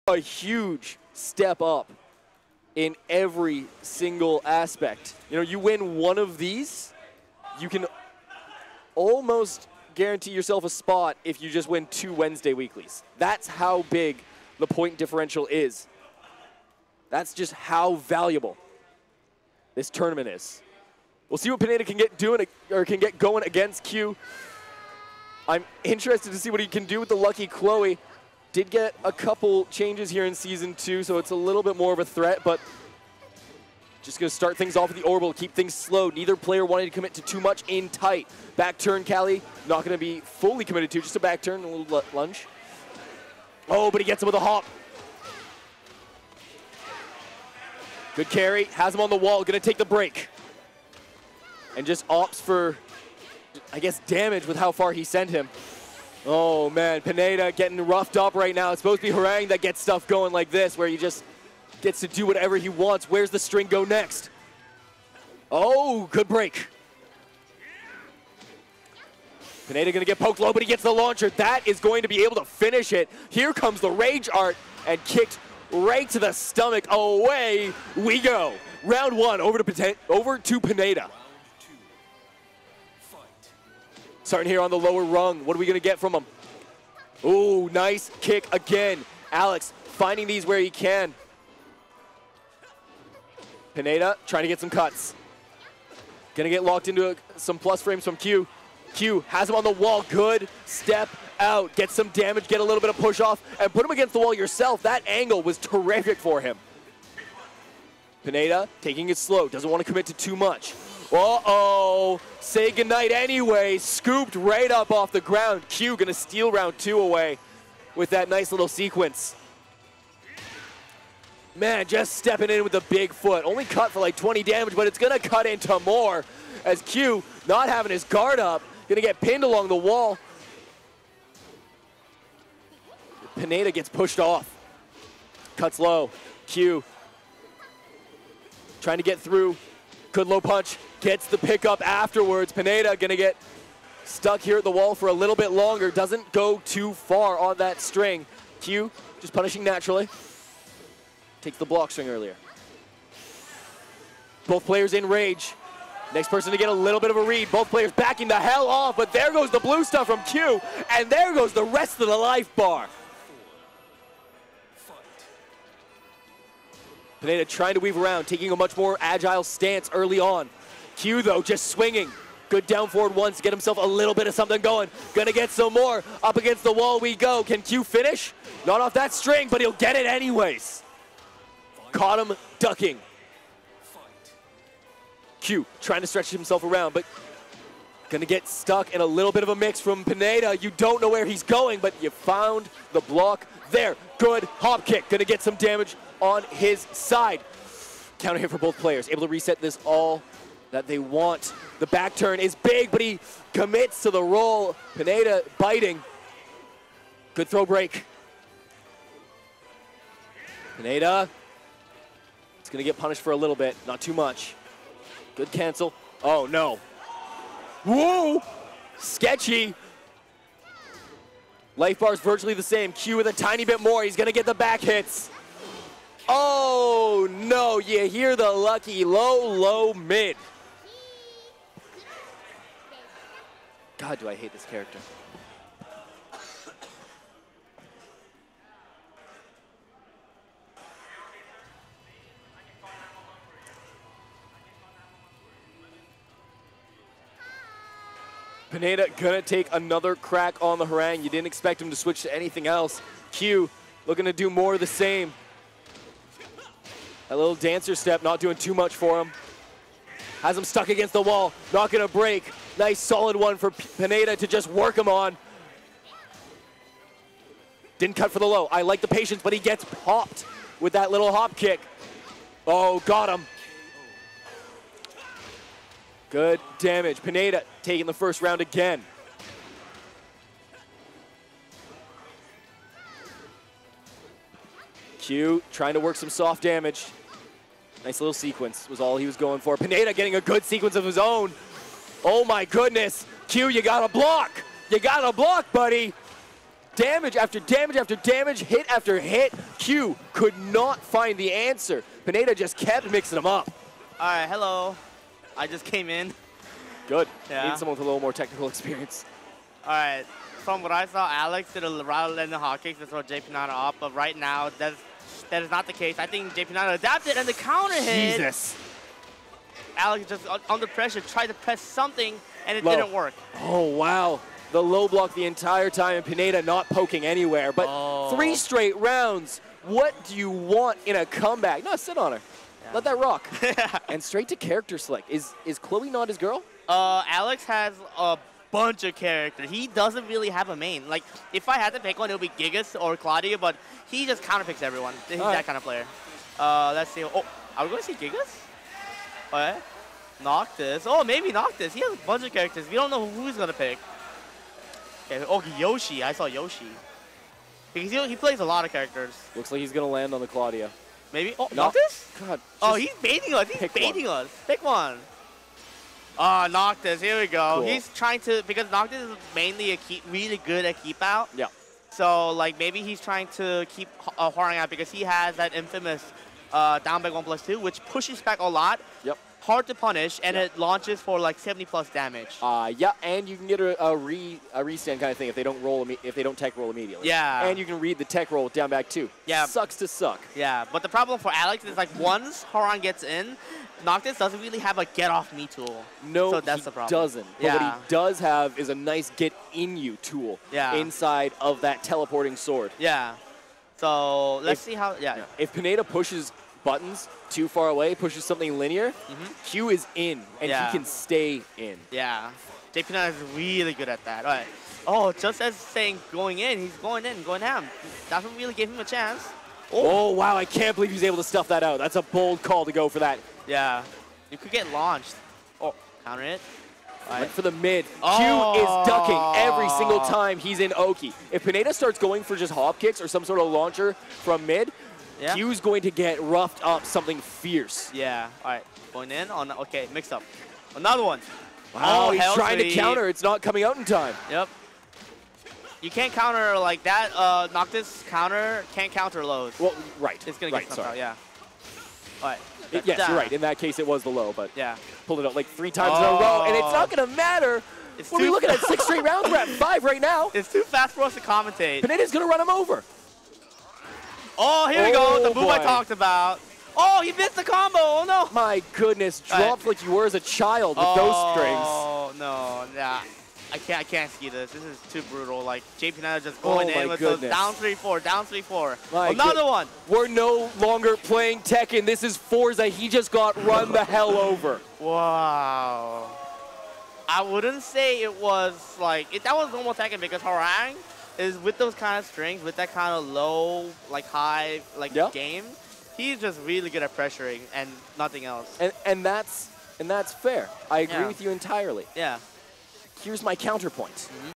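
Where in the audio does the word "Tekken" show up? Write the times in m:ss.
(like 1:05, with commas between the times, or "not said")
8:01, 8:09.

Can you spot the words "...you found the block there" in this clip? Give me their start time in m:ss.
3:12.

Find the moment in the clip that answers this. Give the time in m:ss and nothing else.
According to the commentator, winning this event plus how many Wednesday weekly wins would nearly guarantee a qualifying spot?
0:11.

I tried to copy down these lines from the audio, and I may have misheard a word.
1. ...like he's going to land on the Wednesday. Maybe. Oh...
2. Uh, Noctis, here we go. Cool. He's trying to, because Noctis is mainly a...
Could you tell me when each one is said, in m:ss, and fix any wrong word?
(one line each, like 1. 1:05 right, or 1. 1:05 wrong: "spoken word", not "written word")
1. 5:59 wrong: "Claudio", not "Wednesday"
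2. 6:06 right.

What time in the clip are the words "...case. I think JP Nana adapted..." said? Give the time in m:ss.
5:15.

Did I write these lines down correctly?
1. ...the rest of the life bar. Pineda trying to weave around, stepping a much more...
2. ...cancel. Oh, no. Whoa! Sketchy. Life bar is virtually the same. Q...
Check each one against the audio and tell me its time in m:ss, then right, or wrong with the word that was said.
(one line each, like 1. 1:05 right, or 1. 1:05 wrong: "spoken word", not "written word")
1. 2:41 wrong: "taking", not "stepping"
2. 3:35 right.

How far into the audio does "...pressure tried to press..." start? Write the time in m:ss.
5:20.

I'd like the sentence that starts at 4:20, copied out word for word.
Has him stuck against the wall, not gonna break.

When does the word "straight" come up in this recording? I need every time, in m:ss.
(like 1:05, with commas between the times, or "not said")
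5:28, 5:34, 7:39.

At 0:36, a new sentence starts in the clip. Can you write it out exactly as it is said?
Neither player wanted to commit to too much in tight.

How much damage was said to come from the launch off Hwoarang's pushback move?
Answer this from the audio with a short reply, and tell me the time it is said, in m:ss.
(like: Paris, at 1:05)
70 plus, at 6:21.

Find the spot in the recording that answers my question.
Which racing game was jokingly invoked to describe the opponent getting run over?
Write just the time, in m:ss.
8:02.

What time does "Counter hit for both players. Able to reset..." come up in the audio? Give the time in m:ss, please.
3:18.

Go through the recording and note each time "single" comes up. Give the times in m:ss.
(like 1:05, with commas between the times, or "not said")
0:03, 7:09.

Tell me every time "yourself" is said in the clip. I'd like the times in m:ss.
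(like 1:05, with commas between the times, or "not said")
0:10, 1:44.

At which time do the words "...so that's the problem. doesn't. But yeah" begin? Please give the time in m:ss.
6:36.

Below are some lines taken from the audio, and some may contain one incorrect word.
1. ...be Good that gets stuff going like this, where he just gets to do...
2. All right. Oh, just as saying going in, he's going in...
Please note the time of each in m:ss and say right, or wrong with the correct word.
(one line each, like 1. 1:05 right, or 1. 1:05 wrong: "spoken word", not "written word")
1. 0:59 wrong: "Hwoarang", not "Good"
2. 6:54 right.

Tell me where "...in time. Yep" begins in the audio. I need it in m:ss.
7:23.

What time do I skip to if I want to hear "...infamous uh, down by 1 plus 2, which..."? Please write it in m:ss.
6:15.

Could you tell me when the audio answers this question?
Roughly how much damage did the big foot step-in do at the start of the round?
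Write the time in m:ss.
2:04.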